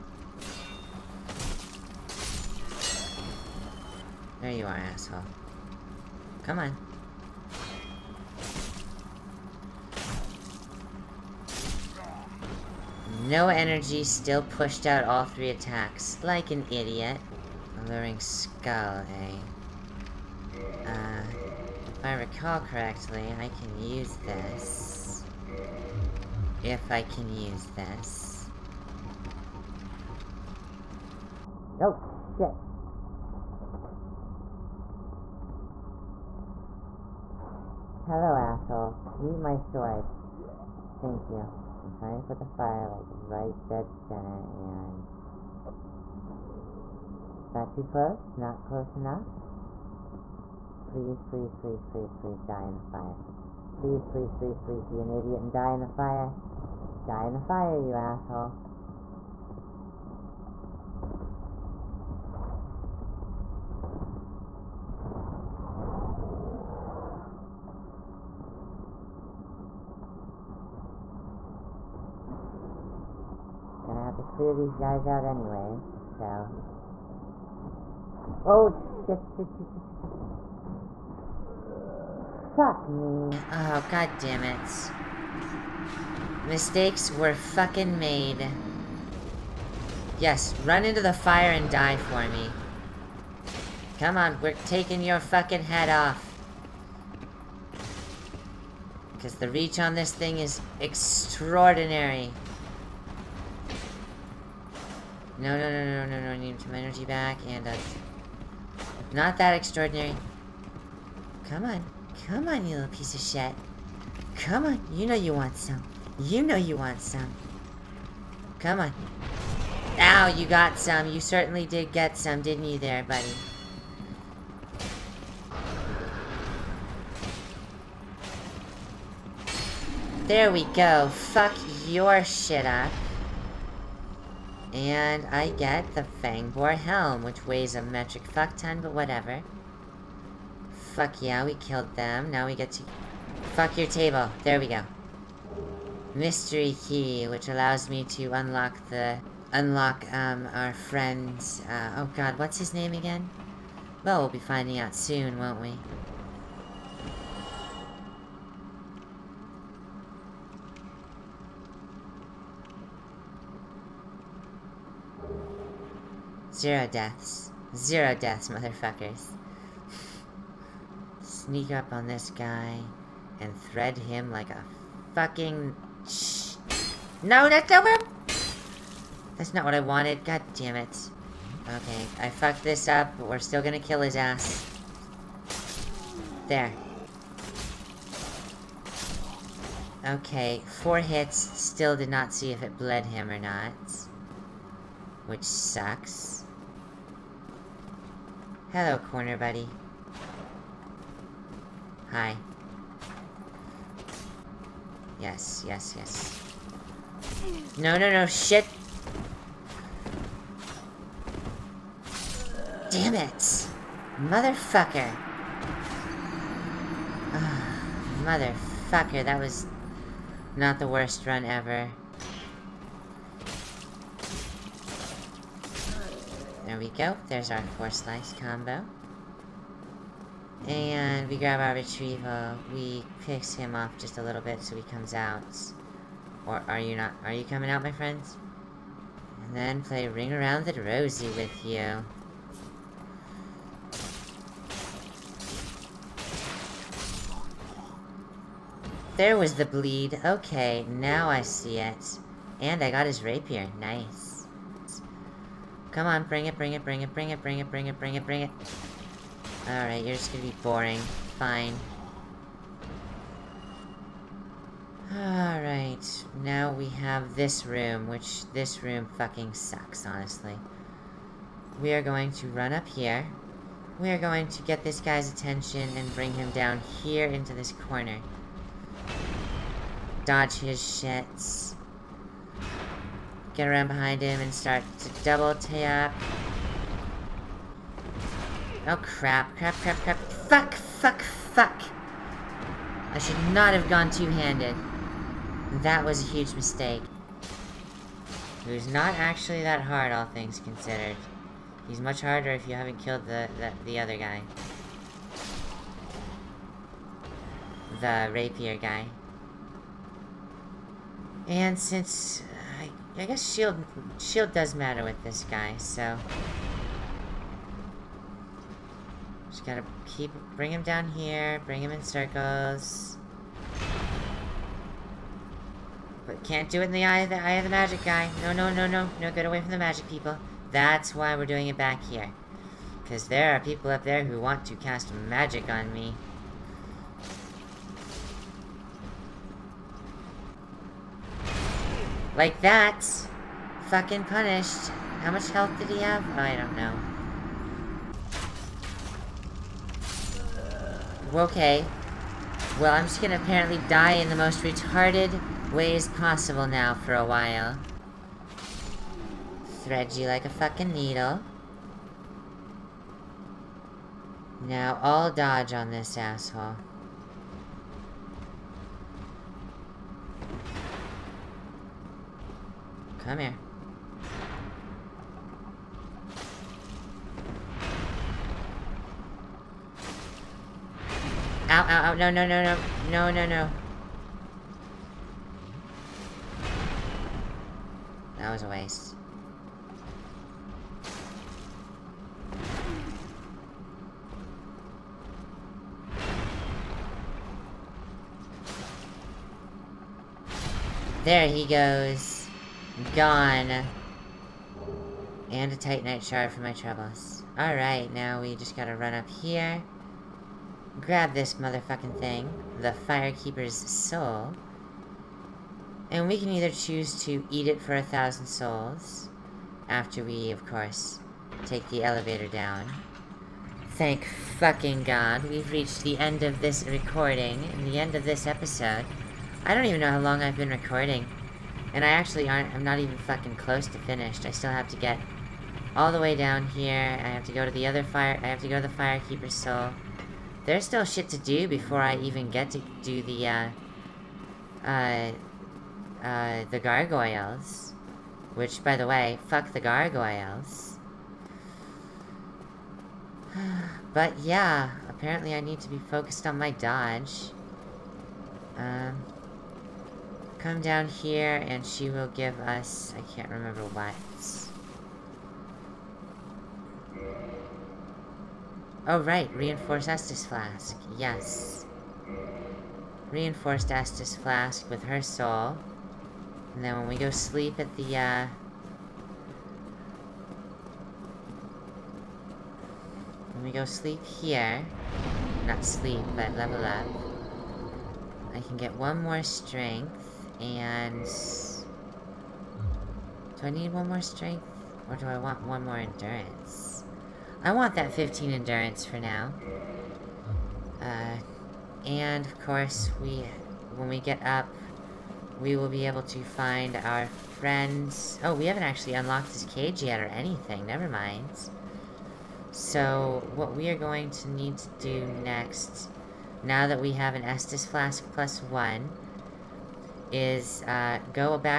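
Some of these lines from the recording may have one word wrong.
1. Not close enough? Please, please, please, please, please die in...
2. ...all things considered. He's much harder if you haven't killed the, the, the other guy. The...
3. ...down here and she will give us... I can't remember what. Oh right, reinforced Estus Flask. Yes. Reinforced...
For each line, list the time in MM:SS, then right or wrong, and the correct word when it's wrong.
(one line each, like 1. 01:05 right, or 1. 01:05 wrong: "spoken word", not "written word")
1. 00:48 right
2. 05:00 right
3. 07:40 right.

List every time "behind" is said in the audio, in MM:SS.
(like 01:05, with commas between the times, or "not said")
04:43.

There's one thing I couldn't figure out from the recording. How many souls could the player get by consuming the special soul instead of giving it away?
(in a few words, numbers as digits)
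1000.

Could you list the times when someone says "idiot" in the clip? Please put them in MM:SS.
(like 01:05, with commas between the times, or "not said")
00:16, 00:55.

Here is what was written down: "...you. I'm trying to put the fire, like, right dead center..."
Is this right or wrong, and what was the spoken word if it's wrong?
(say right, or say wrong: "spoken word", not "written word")
right.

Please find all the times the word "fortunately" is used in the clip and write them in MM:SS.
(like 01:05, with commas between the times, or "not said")
not said.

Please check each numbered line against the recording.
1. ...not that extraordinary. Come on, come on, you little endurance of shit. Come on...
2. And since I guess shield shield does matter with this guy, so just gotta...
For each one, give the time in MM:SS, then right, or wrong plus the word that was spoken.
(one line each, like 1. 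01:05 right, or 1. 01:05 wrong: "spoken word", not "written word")
1. 01:49 wrong: "piece", not "endurance"
2. 05:11 right.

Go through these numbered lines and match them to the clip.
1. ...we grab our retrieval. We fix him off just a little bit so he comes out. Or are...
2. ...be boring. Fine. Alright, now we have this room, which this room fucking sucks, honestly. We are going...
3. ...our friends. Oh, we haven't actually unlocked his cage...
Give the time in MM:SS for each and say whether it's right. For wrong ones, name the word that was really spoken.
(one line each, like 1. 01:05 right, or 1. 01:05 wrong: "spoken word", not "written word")
1. 03:51 right
2. 04:20 right
3. 08:26 right.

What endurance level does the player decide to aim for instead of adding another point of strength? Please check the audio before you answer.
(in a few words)
15.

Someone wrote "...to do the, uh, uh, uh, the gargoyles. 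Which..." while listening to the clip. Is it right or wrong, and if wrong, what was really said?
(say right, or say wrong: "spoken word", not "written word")
right.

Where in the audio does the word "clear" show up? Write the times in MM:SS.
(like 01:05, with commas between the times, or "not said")
01:14.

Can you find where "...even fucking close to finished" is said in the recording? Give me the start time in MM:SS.
07:12.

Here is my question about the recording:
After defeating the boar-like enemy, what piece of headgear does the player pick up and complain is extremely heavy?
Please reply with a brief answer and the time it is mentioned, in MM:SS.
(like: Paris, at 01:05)
Fang Boar Helm, at 02:16.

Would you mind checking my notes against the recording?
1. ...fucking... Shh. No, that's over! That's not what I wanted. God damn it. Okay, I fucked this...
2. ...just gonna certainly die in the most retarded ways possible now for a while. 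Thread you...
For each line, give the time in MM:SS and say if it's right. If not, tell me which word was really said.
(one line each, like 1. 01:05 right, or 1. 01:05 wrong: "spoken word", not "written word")
1. 02:55 right
2. 05:53 wrong: "apparently", not "certainly".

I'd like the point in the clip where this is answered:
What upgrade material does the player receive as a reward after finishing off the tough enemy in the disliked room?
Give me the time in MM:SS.
06:45.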